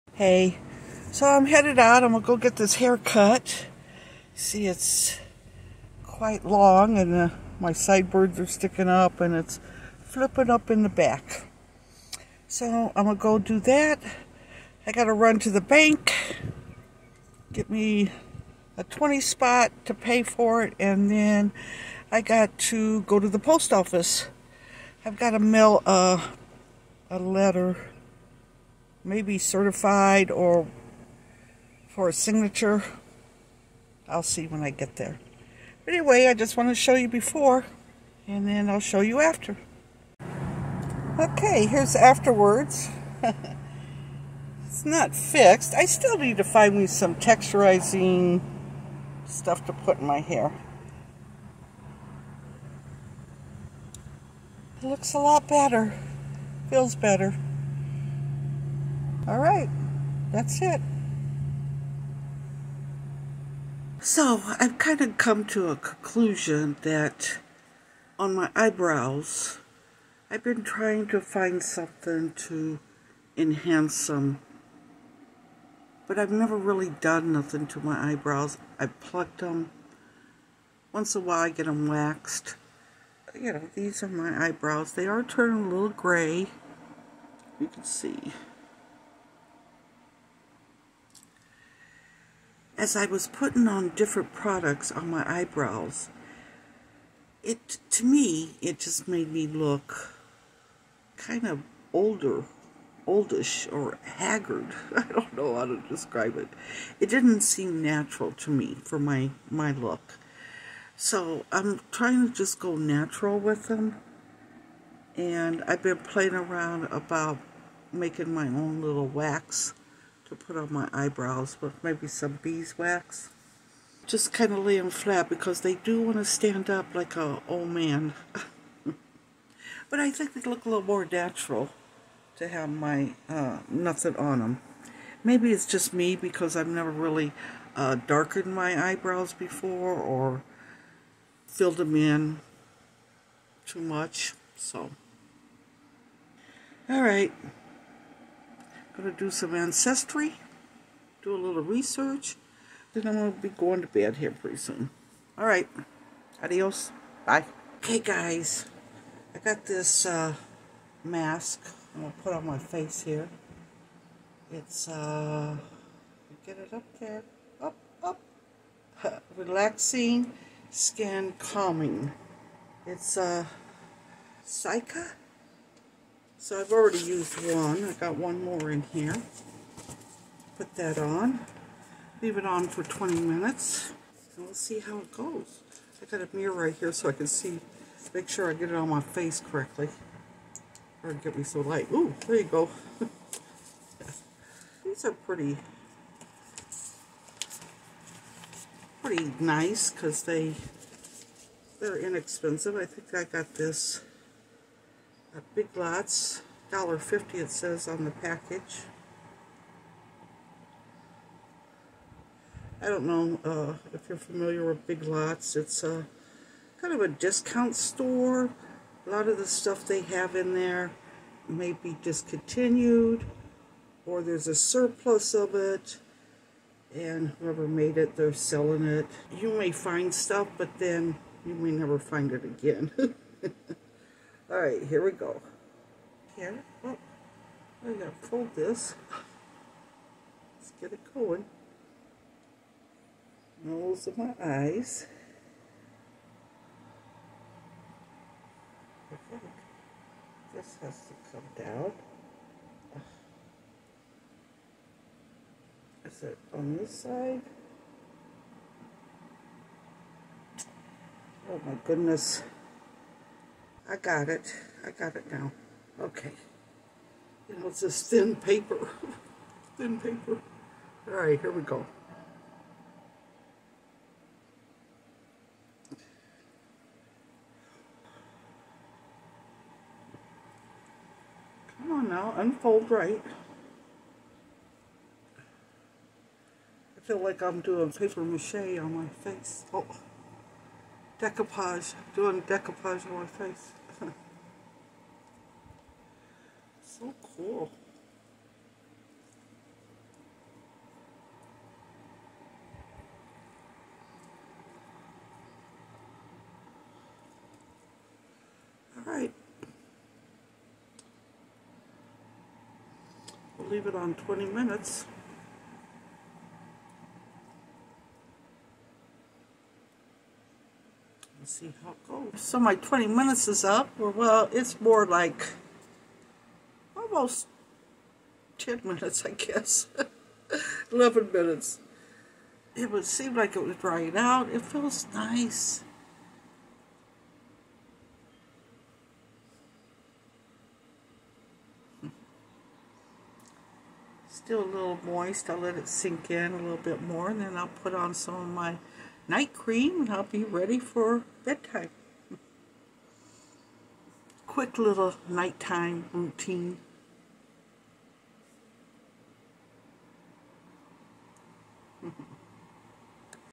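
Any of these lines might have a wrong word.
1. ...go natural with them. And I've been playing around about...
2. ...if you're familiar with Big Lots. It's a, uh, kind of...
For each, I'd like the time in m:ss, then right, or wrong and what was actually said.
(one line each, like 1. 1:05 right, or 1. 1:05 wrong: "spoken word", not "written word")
1. 1:52 right
2. 3:33 right.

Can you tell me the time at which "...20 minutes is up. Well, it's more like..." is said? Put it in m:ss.
5:22.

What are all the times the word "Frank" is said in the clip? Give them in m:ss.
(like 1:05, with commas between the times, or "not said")
not said.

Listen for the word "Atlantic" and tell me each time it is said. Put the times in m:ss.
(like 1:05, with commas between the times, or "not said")
not said.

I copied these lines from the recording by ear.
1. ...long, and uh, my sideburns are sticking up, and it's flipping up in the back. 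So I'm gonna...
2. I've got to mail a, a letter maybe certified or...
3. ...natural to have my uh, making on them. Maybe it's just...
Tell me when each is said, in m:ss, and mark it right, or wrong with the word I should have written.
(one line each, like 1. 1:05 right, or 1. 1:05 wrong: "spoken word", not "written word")
1. 0:06 right
2. 0:25 right
3. 2:11 wrong: "nothing", not "making".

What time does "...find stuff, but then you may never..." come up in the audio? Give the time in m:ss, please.
3:49.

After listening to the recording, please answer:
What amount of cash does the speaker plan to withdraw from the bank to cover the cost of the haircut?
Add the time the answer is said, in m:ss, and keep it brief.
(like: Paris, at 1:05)
$20, at 0:18.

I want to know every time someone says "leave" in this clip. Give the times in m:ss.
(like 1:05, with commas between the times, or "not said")
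3:02, 5:13.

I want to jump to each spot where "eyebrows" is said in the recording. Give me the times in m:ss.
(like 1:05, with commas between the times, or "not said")
1:08, 1:18, 1:24, 1:35, 2:00, 2:18.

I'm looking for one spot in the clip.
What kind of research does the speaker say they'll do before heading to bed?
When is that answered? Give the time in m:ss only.
2:29.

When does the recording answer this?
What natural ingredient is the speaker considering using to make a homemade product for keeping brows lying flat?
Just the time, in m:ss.
2:02.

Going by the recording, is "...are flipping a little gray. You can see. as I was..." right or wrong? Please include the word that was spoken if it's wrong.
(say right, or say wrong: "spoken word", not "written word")
wrong: "turning", not "flipping".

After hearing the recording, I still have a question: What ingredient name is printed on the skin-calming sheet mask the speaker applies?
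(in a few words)
Cica.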